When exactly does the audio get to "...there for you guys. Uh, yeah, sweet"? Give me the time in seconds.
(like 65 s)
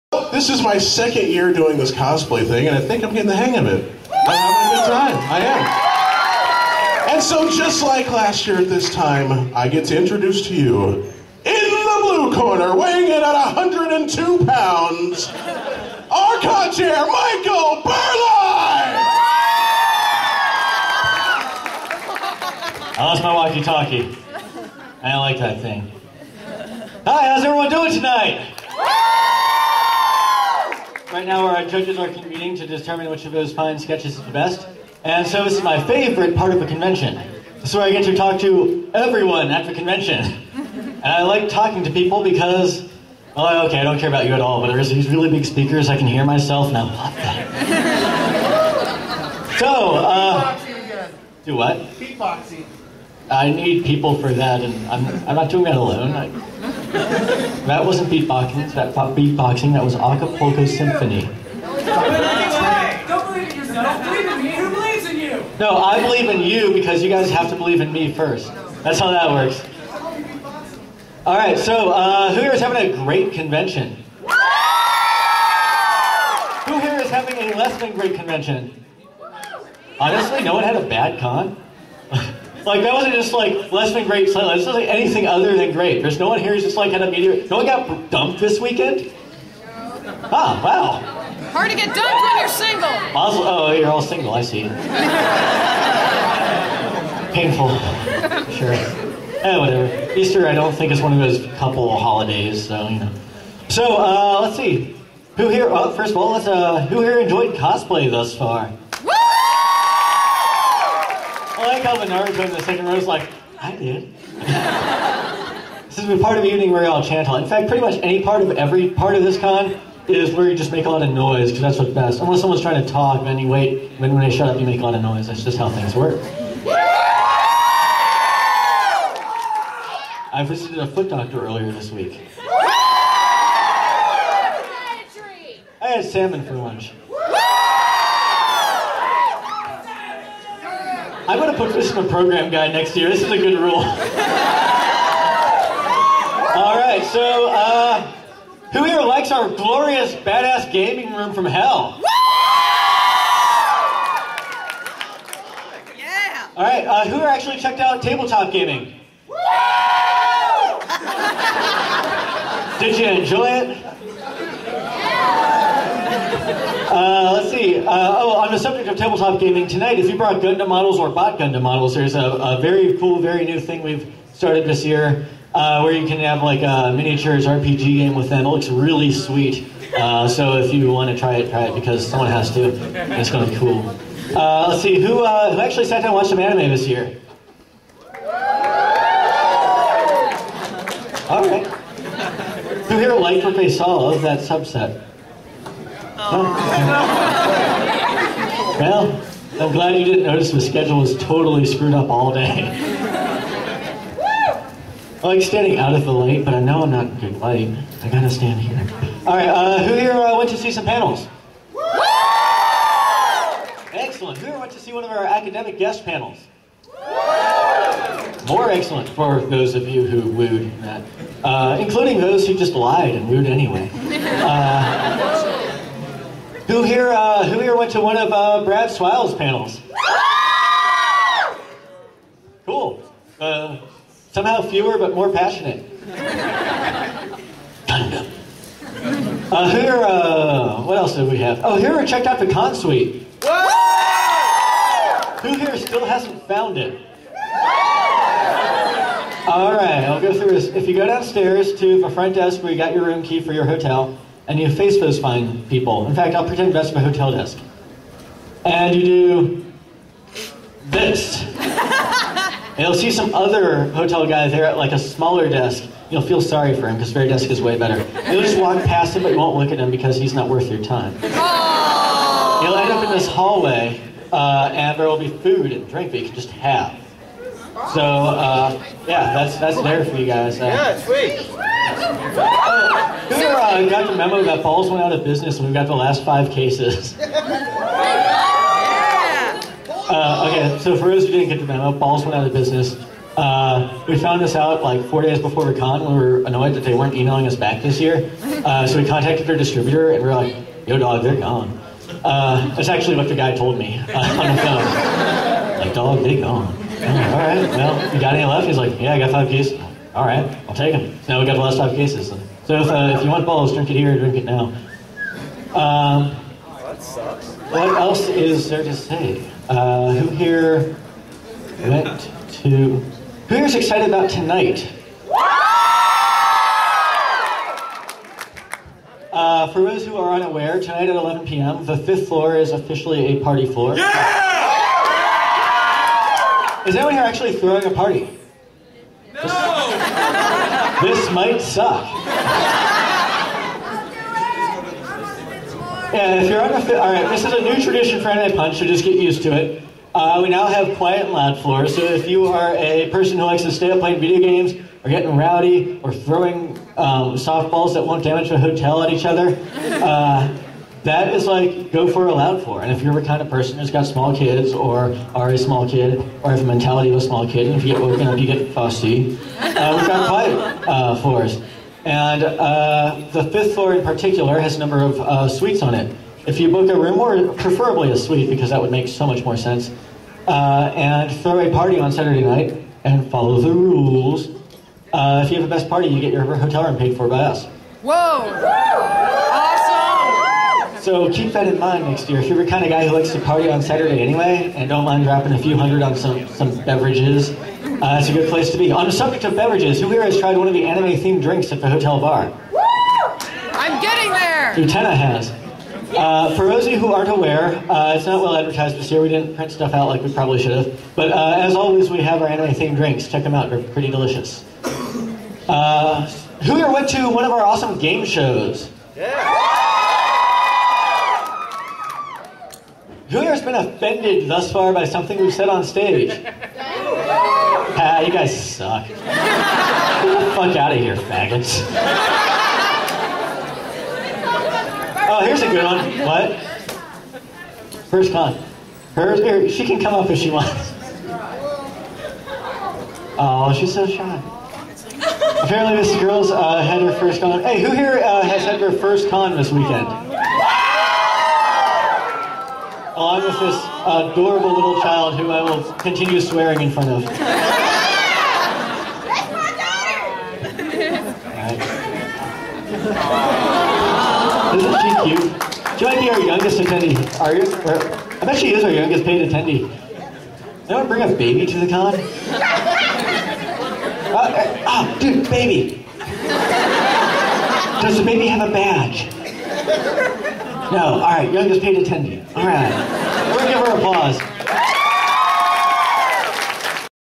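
279 s.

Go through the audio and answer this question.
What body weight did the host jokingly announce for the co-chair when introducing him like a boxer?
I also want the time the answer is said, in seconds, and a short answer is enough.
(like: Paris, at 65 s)
102 pounds, at 13 s.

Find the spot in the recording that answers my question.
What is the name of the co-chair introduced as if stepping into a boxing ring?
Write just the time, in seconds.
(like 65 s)
16 s.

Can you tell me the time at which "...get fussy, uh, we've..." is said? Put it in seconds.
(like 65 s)
368 s.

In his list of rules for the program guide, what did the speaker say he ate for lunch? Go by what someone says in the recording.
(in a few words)
Salmon.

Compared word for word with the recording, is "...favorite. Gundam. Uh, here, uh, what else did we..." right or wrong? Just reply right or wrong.
wrong.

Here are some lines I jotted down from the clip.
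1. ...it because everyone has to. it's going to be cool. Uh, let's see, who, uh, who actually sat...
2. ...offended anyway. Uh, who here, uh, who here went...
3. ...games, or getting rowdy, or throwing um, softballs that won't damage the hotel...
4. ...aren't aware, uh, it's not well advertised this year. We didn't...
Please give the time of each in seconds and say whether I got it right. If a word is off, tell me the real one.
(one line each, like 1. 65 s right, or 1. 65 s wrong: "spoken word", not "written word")
1. 181 s wrong: "someone", not "everyone"
2. 223 s wrong: "wooed", not "offended"
3. 354 s right
4. 407 s right.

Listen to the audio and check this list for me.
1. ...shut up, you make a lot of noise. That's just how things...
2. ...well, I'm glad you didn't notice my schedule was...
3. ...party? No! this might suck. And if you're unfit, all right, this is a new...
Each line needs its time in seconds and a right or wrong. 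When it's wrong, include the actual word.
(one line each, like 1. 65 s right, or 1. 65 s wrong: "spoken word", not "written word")
1. 124 s right
2. 196 s right
3. 337 s right.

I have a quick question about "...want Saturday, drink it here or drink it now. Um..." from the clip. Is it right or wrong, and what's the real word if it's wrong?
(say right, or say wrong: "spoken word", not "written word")
wrong: "Bawls", not "Saturday".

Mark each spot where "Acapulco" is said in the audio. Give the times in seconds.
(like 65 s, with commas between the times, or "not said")
59 s.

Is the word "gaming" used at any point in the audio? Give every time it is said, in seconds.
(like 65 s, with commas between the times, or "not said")
150 s, 158 s, 169 s.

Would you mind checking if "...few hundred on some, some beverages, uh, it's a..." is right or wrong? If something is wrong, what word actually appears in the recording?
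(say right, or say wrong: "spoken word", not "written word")
right.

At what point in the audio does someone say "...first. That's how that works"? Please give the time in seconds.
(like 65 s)
68 s.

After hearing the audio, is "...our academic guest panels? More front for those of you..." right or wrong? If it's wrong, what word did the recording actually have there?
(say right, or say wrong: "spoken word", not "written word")
wrong: "excellent", not "front".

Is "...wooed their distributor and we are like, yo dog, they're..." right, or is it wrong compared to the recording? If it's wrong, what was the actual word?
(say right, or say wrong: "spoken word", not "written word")
wrong: "contacted", not "wooed".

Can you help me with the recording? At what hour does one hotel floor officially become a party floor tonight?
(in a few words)
11 p.m.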